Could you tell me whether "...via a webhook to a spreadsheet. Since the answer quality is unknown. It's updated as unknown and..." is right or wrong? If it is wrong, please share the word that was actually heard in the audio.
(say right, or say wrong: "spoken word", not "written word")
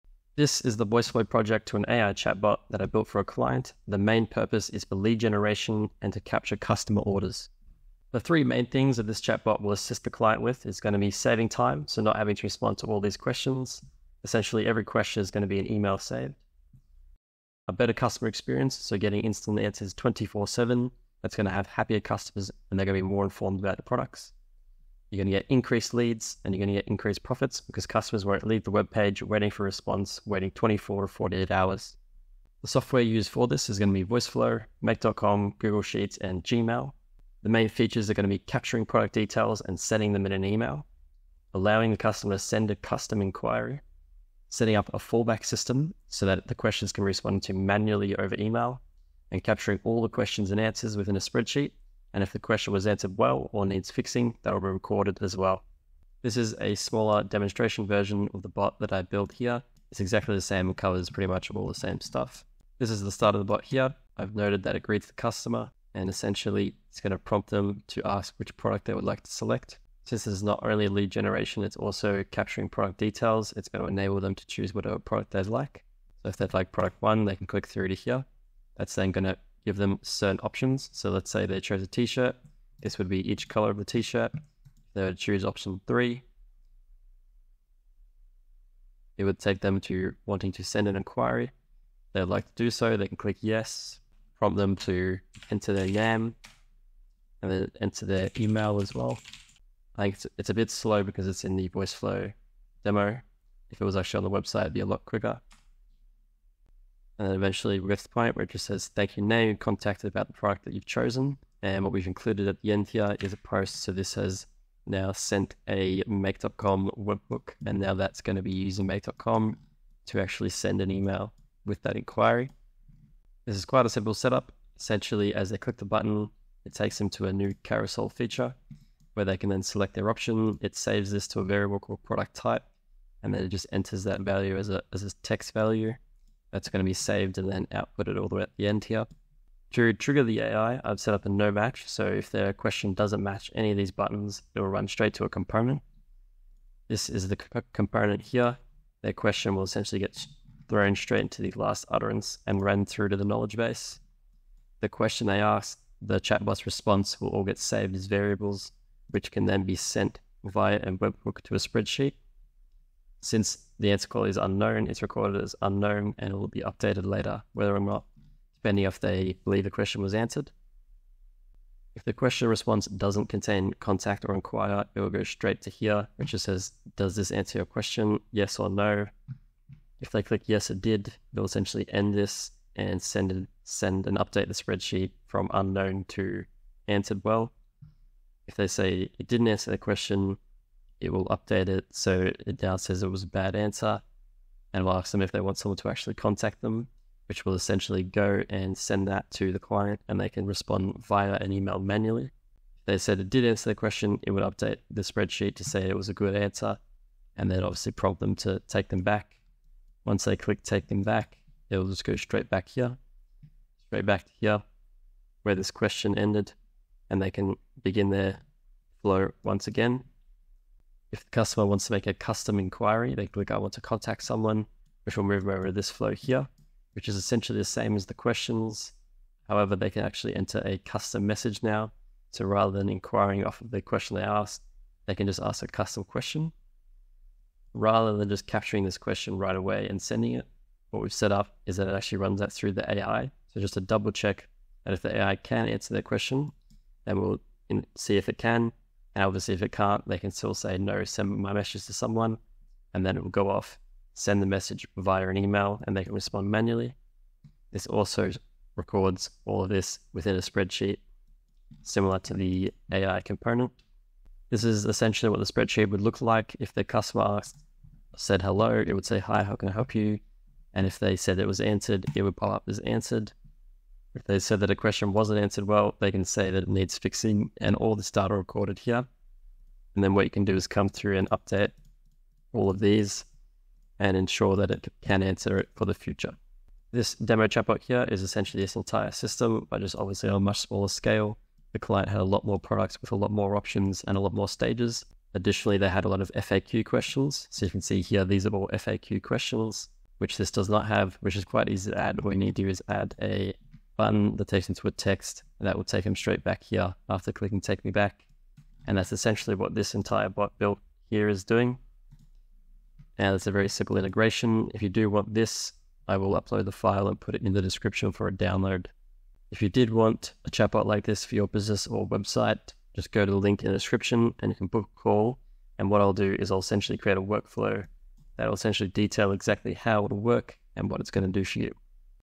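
wrong: "recorded", not "updated".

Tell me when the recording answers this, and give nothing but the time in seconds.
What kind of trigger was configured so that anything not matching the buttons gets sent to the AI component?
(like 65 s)
141 s.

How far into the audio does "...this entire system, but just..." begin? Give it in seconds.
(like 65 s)
288 s.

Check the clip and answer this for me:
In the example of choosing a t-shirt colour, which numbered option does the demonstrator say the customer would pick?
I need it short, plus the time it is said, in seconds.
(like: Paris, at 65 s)
option 3, at 85 s.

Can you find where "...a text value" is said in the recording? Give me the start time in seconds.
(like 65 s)
135 s.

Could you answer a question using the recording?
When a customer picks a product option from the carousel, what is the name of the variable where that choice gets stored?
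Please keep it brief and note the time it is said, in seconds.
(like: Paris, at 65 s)
product type, at 132 s.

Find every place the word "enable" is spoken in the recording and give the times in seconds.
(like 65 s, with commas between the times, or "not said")
73 s.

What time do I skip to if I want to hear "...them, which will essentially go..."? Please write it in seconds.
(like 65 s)
196 s.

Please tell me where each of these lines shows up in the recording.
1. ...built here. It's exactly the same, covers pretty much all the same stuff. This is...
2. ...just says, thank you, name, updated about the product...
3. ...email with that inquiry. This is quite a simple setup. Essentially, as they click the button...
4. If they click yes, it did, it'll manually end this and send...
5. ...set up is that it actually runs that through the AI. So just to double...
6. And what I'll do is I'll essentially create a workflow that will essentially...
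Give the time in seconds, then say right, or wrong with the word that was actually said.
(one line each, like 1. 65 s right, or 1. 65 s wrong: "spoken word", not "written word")
1. 59 s right
2. 108 s wrong: "contacted", not "updated"
3. 120 s right
4. 179 s wrong: "essentially", not "manually"
5. 241 s right
6. 325 s right.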